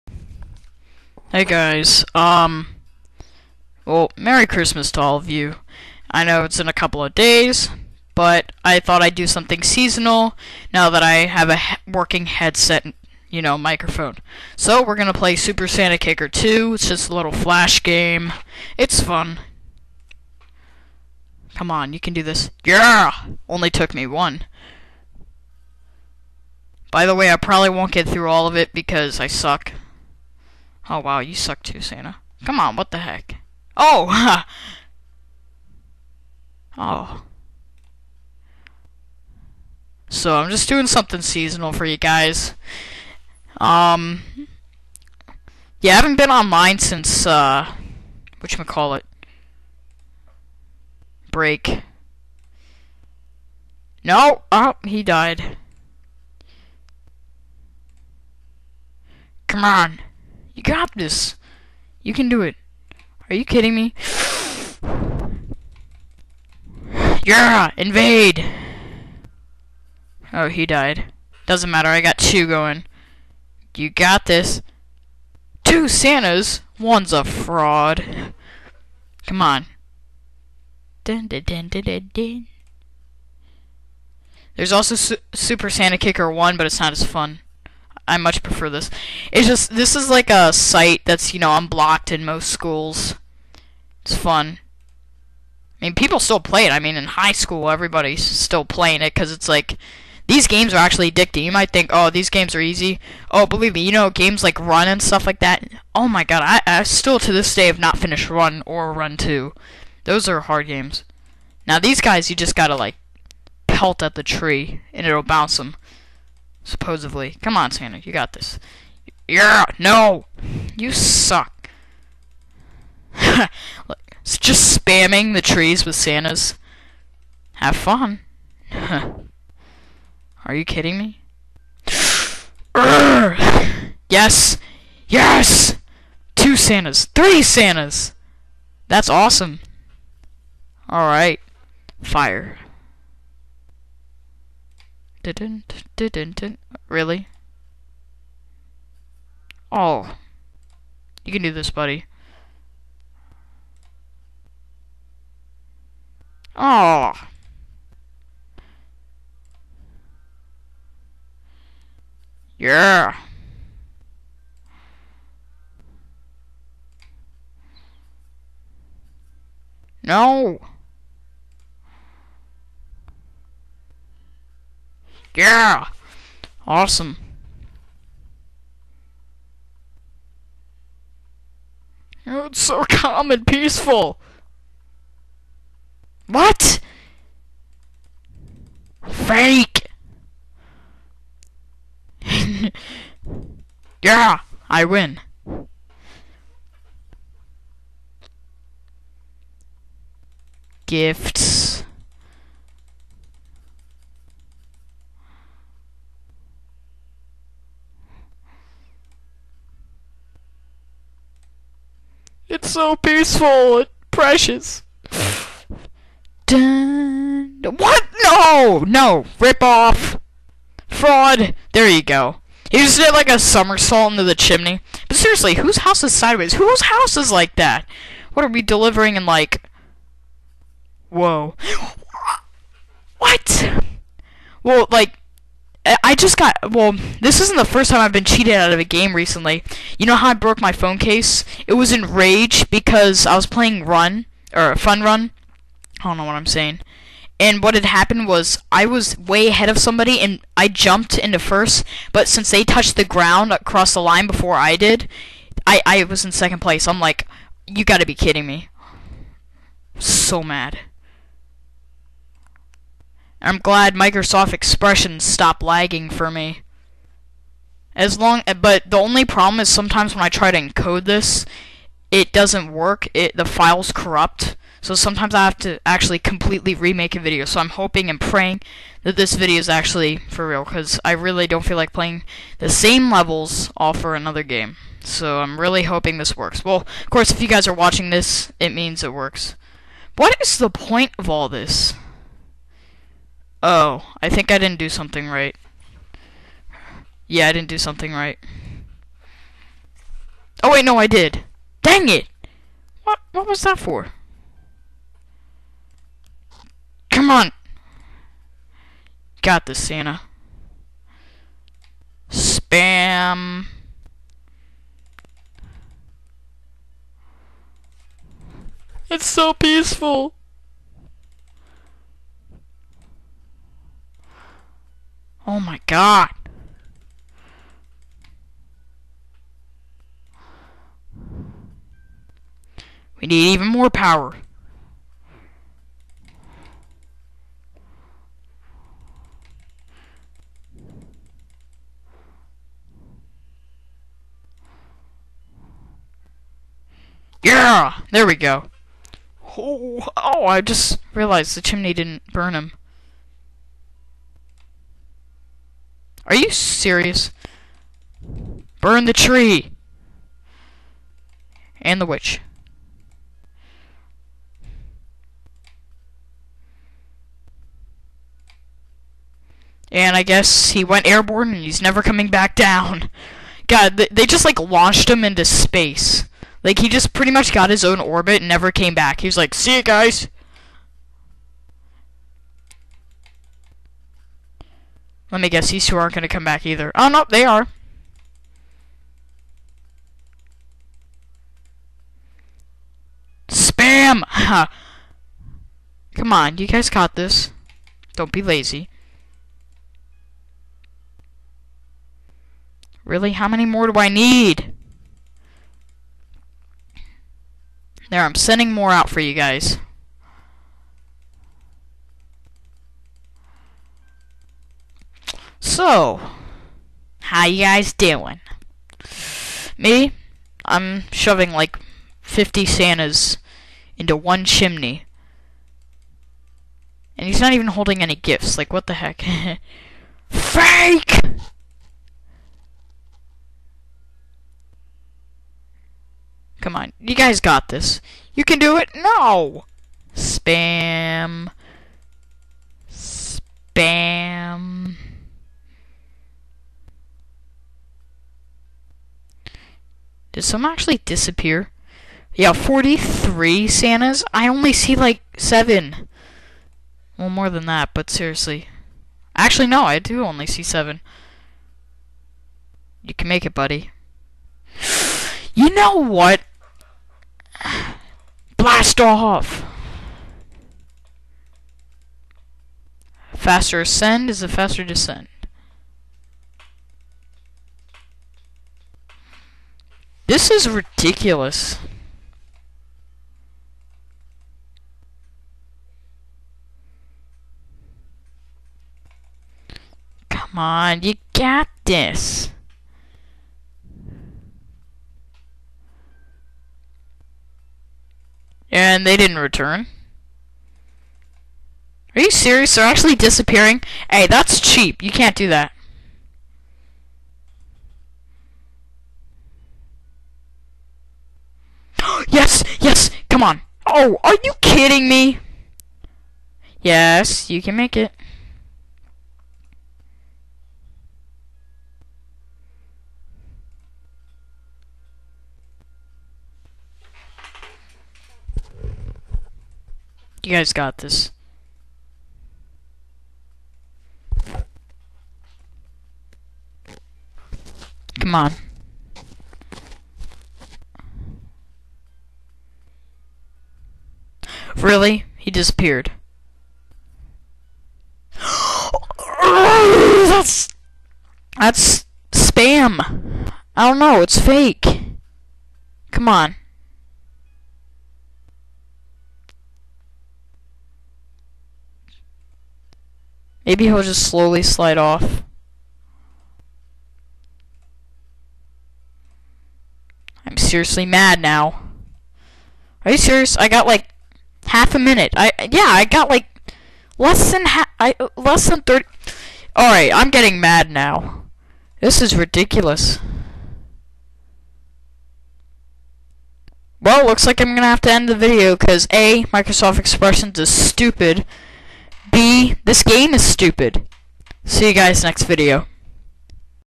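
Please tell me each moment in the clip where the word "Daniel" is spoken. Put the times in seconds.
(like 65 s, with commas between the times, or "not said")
not said.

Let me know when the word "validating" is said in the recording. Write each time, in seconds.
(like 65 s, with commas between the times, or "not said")
not said.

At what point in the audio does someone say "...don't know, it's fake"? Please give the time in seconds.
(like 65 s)
553 s.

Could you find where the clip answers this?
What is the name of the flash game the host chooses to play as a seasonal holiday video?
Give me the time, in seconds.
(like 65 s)
15 s.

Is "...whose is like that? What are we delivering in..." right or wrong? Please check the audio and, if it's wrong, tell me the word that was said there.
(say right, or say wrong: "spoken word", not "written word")
wrong: "house", not "whose".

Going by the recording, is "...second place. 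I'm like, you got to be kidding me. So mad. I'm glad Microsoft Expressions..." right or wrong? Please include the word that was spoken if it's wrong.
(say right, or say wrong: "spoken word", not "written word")
right.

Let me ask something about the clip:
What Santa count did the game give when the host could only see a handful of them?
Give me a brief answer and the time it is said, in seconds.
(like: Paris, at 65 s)
43, at 452 s.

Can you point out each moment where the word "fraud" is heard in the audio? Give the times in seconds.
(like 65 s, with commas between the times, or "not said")
77 s, 220 s.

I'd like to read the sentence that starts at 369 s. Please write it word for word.
And I guess he went airborne and he's never coming back down.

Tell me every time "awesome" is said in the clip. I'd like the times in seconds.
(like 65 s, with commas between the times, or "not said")
139 s, 176 s.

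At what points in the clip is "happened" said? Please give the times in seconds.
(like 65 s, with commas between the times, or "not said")
247 s.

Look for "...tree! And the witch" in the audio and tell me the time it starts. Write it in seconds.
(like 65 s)
359 s.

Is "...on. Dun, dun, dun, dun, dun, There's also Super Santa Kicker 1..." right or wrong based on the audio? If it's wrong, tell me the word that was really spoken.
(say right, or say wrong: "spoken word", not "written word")
right.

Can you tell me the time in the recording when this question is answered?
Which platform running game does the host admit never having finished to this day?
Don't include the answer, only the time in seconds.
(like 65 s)
108 s.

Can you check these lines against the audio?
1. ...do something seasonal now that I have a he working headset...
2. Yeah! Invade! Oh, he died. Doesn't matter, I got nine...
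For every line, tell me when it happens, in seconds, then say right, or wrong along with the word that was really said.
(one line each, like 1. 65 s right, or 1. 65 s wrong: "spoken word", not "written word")
1. 9 s right
2. 67 s wrong: "two", not "nine".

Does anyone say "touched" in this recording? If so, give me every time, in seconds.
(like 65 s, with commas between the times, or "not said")
252 s.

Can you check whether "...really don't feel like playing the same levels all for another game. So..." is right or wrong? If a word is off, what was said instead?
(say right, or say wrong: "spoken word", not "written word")
right.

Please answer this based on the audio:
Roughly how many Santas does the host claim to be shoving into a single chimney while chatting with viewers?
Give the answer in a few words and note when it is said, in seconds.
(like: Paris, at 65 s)
50, at 422 s.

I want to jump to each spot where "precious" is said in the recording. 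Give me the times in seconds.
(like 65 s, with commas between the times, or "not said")
214 s.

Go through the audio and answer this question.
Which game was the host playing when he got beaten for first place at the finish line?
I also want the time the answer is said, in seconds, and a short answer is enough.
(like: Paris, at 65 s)
Fun Run, at 244 s.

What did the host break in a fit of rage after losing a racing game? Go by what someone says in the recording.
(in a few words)
phone case.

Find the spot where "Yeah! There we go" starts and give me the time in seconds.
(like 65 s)
347 s.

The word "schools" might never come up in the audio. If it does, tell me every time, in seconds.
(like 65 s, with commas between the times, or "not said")
92 s, 97 s.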